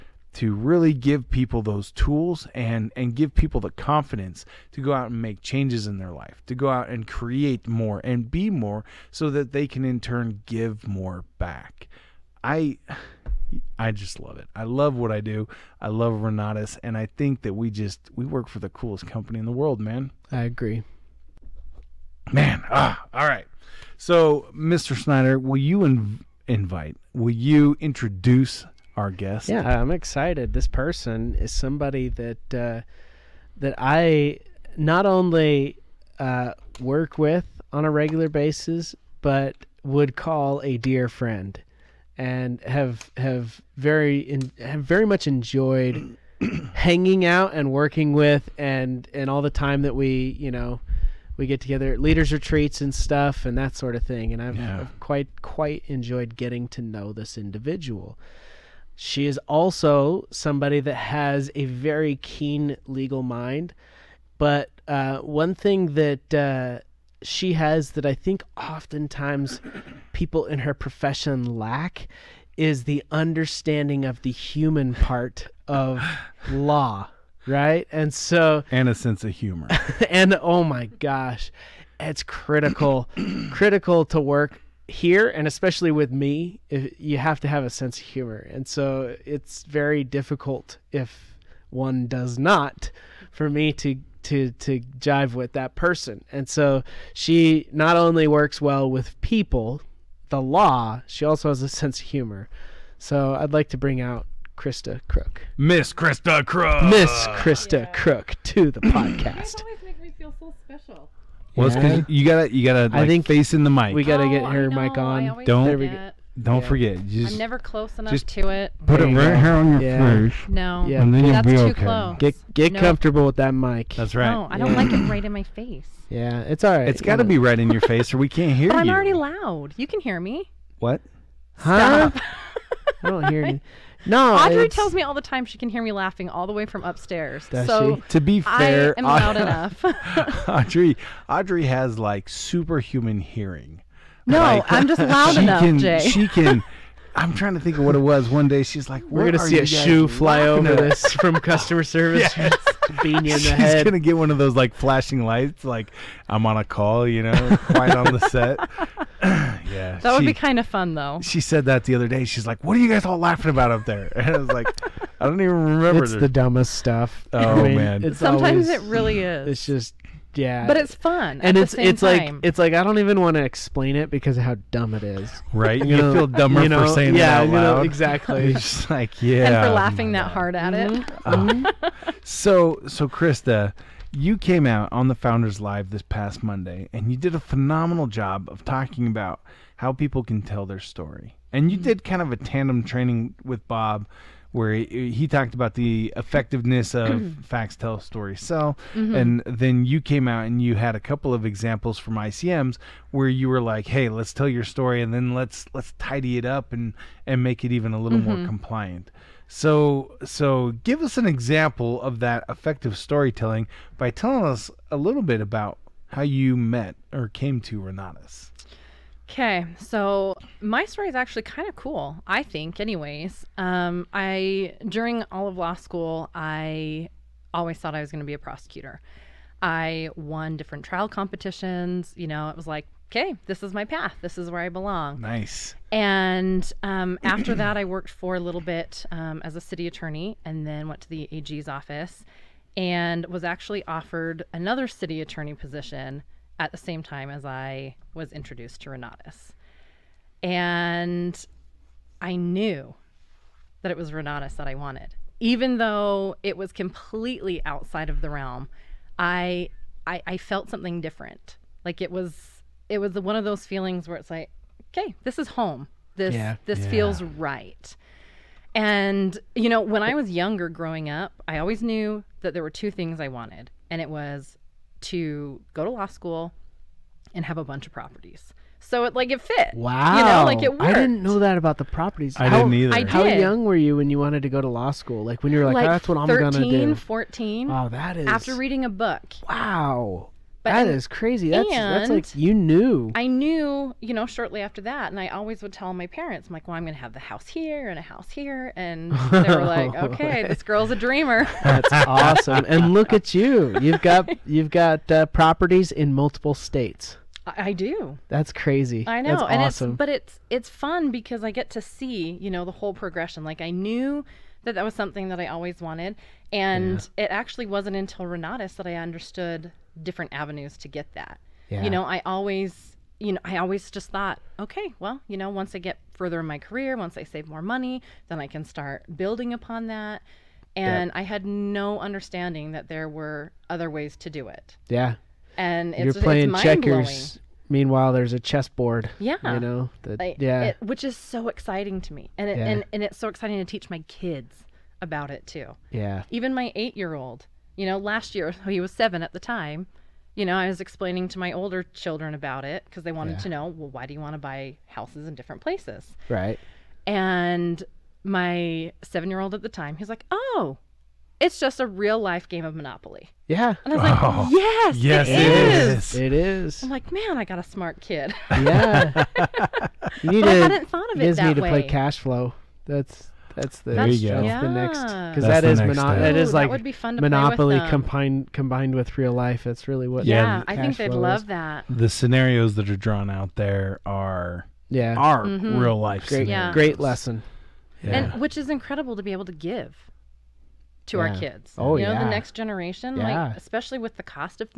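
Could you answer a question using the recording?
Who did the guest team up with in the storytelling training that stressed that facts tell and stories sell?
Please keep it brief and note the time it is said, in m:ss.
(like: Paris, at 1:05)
Bob, at 3:13.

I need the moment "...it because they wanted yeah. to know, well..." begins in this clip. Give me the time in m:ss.
5:52.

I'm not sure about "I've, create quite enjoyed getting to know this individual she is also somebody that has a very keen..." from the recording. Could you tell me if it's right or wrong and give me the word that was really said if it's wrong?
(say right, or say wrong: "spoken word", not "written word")
wrong: "quite", not "create".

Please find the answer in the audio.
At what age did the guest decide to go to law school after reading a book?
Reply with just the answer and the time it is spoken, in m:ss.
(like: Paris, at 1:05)
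14, at 4:46.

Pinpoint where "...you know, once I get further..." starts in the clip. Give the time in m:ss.
5:25.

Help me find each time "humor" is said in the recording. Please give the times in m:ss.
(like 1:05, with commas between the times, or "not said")
1:19, 1:28, 1:42.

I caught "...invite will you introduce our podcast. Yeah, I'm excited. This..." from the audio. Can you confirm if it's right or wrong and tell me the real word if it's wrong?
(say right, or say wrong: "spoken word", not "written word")
wrong: "guest", not "podcast".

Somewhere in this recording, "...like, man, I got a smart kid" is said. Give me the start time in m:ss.
6:06.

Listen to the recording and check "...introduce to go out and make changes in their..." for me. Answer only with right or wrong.
wrong.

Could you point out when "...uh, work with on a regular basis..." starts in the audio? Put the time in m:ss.
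0:36.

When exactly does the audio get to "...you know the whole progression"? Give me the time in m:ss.
5:12.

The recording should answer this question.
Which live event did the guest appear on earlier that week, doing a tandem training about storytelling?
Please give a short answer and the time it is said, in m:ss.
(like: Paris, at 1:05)
Founders Live, at 3:05.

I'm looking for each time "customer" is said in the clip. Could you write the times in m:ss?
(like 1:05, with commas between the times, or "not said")
2:31.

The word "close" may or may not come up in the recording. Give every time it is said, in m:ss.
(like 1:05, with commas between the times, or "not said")
1:57, 2:01.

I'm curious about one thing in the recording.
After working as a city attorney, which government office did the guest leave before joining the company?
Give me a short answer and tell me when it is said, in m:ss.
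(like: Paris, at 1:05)
the AG's office, at 4:01.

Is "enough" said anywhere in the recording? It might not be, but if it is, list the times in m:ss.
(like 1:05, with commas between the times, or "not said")
1:57, 2:19, 2:25.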